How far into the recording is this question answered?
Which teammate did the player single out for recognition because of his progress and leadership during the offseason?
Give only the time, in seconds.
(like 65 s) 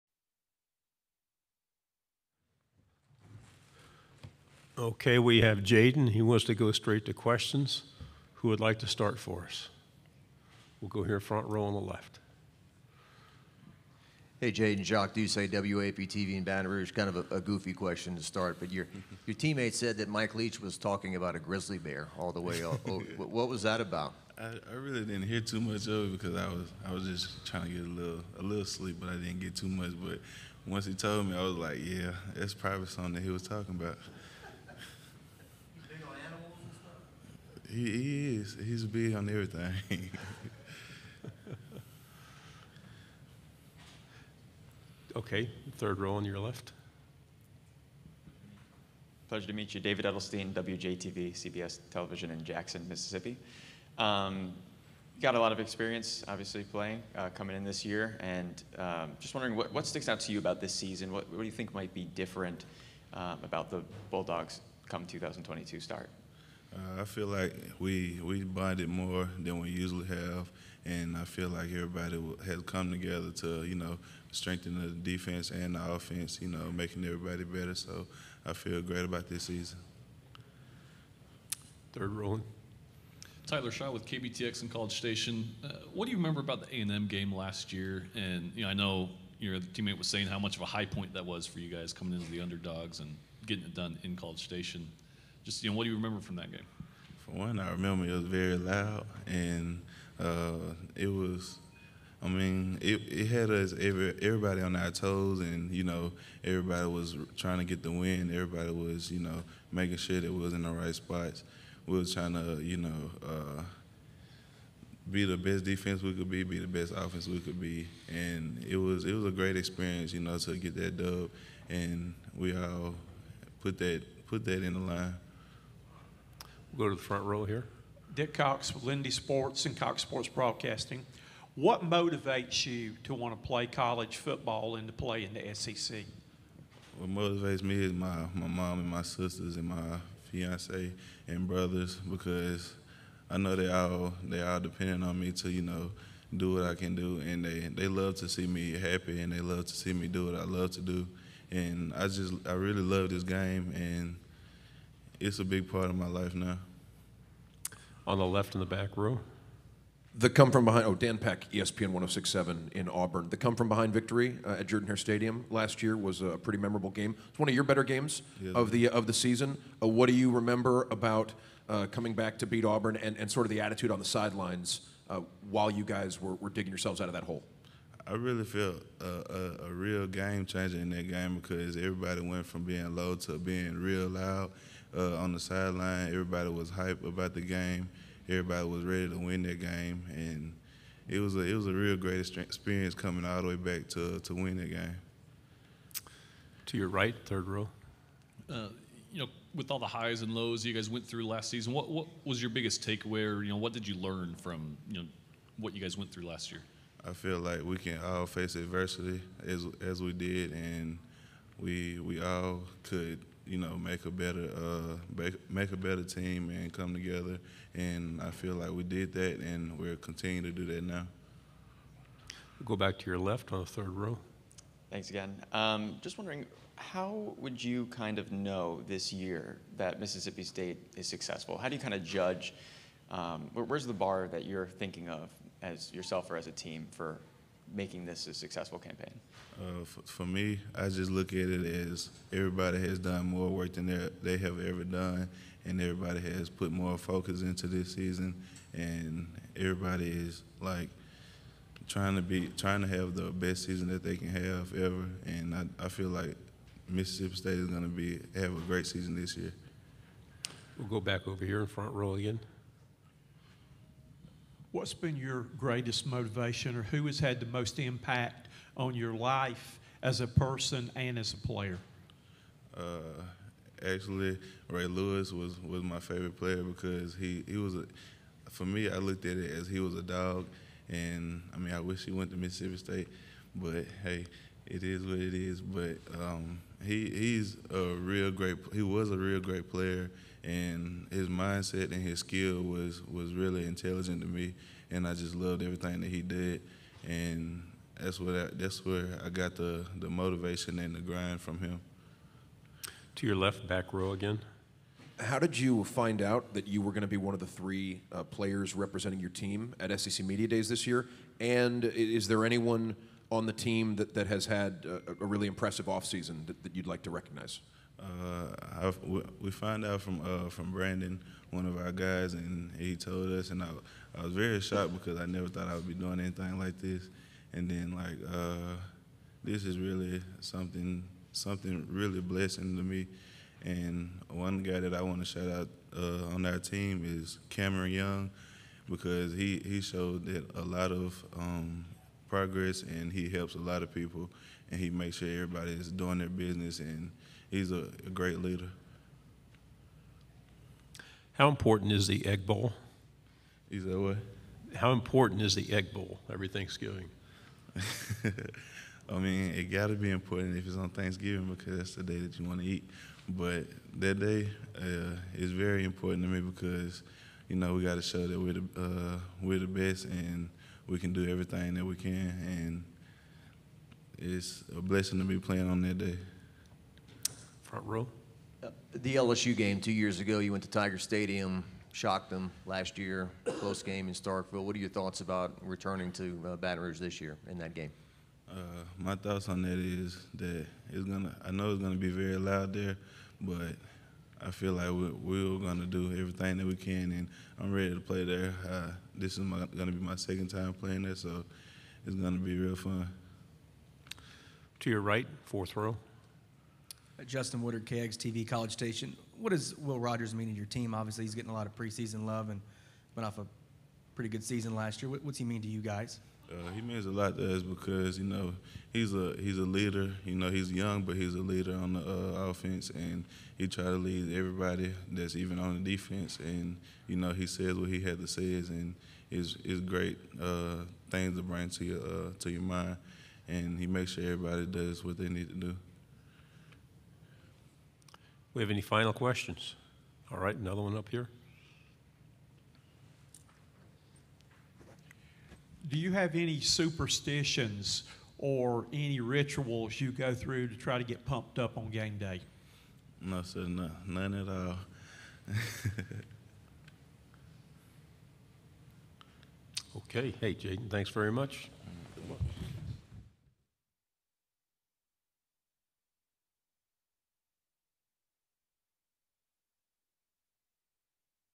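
337 s.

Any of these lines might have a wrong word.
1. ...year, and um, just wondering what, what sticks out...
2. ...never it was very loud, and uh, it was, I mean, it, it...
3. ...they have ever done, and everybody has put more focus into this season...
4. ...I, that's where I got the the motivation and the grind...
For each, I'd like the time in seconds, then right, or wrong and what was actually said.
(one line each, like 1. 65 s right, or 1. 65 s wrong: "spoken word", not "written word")
1. 57 s right
2. 97 s wrong: "remember", not "never"
3. 244 s right
4. 298 s right.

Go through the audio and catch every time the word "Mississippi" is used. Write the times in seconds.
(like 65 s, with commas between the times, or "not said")
52 s, 230 s, 256 s, 282 s.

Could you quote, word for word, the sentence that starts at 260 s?
We'll go back over here in front row again.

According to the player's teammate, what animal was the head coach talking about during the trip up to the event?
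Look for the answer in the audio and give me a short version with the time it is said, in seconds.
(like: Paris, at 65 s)
Grizzly bear, at 21 s.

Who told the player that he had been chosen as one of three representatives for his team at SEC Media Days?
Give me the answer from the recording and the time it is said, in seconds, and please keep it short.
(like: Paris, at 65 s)
Brandon, at 320 s.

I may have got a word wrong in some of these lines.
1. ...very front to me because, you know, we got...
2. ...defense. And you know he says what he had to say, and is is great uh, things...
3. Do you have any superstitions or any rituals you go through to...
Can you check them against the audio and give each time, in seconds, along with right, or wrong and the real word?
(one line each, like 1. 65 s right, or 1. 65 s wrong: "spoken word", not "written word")
1. 365 s wrong: "important", not "front"
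2. 425 s right
3. 445 s right.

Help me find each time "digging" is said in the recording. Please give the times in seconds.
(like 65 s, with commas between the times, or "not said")
176 s.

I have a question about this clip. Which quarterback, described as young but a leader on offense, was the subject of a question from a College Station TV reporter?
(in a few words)
Will Rogers.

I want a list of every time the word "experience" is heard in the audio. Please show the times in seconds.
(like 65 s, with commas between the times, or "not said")
55 s, 119 s, 192 s.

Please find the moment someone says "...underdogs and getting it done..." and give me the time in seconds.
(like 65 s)
92 s.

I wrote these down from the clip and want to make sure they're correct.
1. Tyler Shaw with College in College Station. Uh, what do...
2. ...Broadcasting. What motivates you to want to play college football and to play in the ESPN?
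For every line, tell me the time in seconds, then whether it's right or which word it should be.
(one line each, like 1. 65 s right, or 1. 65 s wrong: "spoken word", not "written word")
1. 83 s wrong: "KBTX", not "College"
2. 130 s wrong: "SEC", not "ESPN".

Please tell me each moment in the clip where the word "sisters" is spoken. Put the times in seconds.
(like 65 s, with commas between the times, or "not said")
139 s.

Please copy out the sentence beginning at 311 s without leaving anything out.
And is there anyone on the team that, that has had a, a really impressive offseason that, that you'd like to recognize?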